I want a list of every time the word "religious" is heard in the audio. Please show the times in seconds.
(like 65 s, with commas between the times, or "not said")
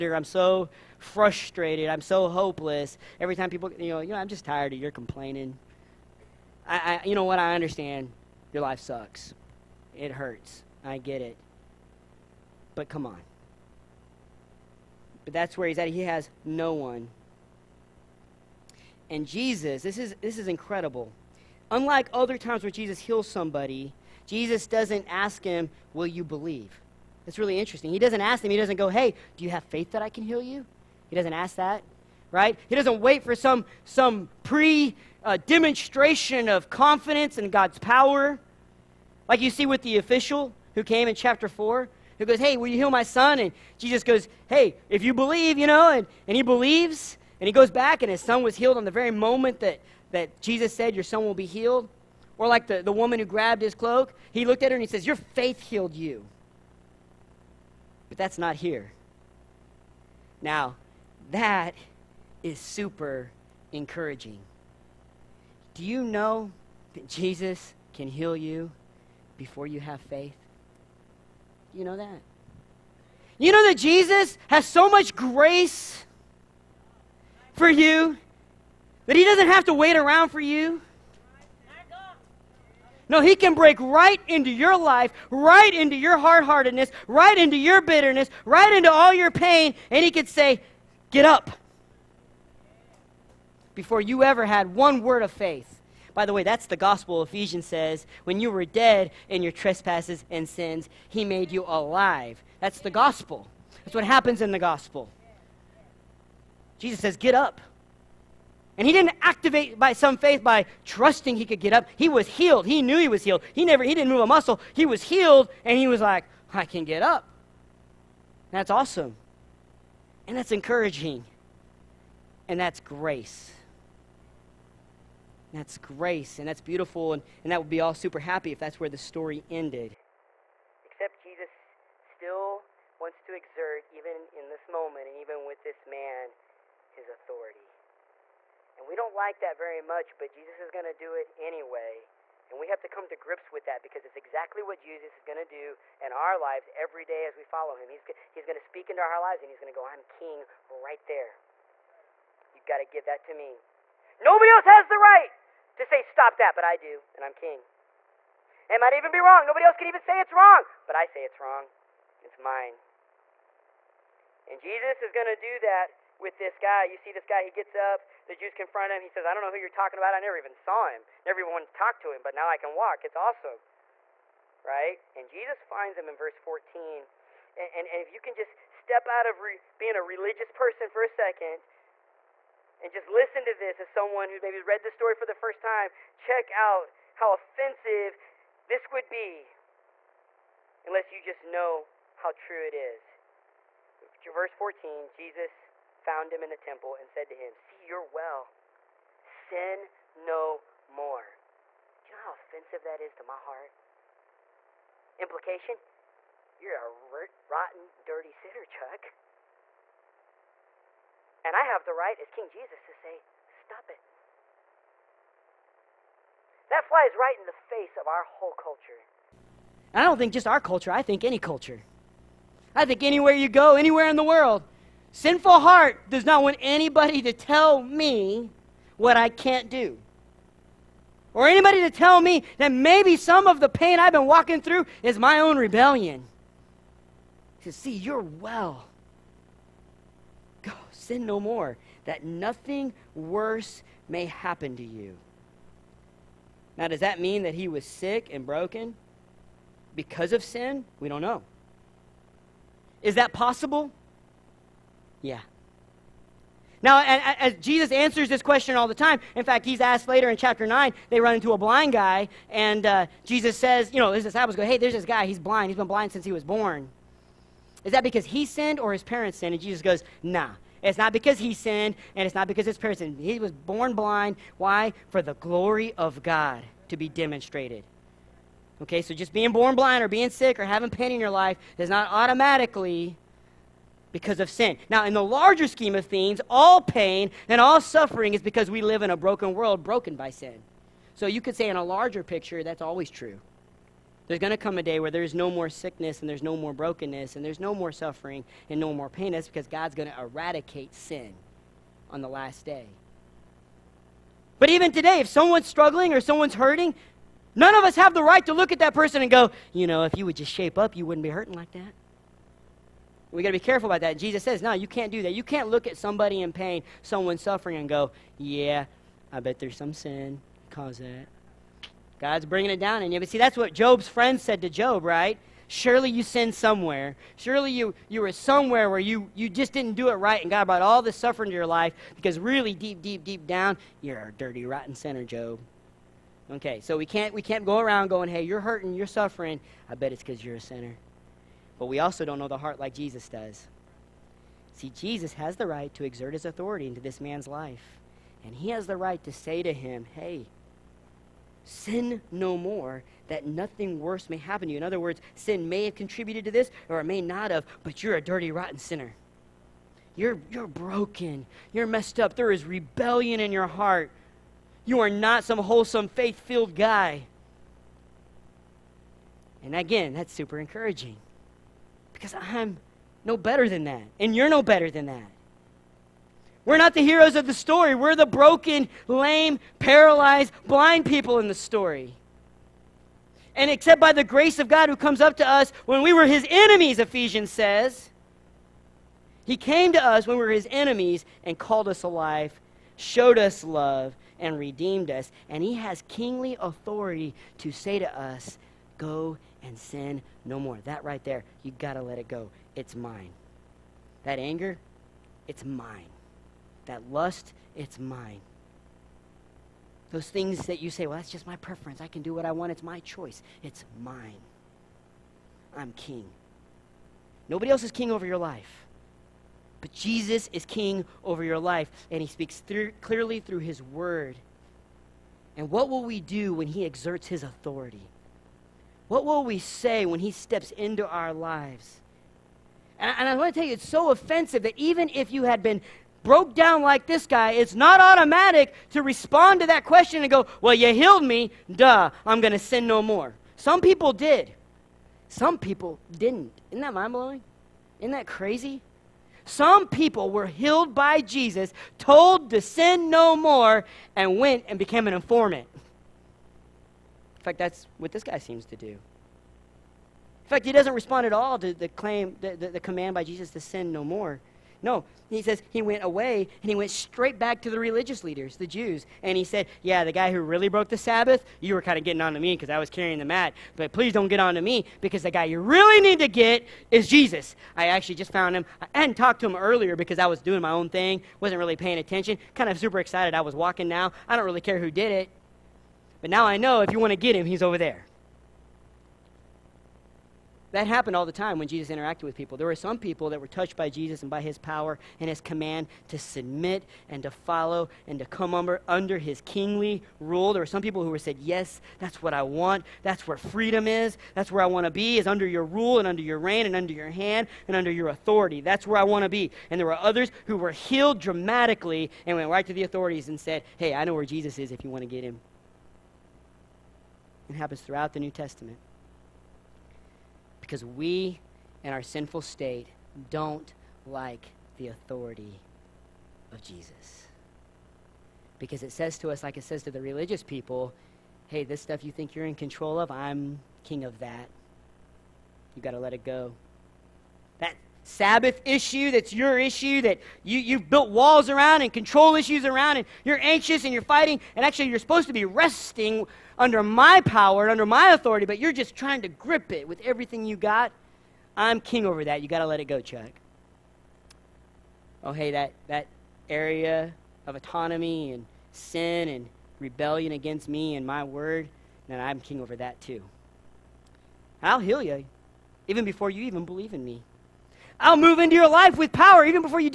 180 s, 467 s, 530 s.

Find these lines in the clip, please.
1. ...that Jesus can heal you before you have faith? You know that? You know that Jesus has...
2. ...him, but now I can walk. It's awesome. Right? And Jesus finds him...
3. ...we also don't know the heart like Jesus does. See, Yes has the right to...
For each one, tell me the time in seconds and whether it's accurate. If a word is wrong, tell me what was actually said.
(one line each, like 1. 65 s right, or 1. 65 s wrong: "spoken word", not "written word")
1. 66 s right
2. 172 s right
3. 341 s wrong: "Jesus", not "Yes".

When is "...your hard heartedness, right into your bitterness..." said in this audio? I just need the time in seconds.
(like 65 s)
85 s.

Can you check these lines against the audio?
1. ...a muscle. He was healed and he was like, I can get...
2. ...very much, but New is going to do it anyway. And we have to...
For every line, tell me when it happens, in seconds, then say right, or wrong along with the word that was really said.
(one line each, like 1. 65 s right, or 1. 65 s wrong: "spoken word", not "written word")
1. 114 s right
2. 139 s wrong: "Jesus", not "New".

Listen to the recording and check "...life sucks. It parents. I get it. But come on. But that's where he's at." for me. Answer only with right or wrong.
wrong.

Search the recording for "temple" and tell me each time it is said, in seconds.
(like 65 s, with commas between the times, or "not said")
196 s.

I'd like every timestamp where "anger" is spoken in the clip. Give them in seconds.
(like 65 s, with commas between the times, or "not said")
404 s.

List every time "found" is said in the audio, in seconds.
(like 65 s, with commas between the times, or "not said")
196 s, 478 s.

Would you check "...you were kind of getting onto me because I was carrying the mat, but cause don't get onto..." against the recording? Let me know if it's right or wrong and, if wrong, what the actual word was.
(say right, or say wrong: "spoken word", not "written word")
wrong: "please", not "cause".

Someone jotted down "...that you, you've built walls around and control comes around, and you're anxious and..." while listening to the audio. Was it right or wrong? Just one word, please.
wrong.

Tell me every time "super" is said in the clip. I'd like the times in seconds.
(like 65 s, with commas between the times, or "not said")
62 s, 127 s, 370 s, 482 s.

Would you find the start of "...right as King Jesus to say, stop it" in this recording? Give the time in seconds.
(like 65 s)
211 s.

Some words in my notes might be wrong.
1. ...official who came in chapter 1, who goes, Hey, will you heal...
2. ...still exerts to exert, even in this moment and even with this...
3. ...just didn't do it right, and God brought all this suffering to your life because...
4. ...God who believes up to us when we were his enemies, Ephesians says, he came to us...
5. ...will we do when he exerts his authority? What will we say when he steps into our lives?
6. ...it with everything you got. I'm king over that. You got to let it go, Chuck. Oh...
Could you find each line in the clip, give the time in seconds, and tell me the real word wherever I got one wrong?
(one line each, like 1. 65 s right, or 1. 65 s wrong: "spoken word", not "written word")
1. 39 s wrong: "4", not "1"
2. 132 s wrong: "wants", not "exerts"
3. 329 s right
4. 384 s wrong: "comes", not "believes"
5. 425 s right
6. 549 s right.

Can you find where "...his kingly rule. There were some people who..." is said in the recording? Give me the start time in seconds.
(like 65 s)
499 s.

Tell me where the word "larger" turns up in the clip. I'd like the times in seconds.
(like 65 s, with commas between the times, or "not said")
285 s, 291 s.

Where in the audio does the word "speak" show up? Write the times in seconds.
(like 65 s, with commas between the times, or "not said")
148 s, 422 s.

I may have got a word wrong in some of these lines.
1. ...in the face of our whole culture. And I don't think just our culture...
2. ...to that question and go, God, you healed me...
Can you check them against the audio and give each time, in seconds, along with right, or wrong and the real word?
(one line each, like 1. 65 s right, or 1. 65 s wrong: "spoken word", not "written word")
1. 217 s right
2. 439 s wrong: "Well", not "God".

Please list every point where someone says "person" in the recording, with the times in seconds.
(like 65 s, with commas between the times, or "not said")
180 s, 308 s.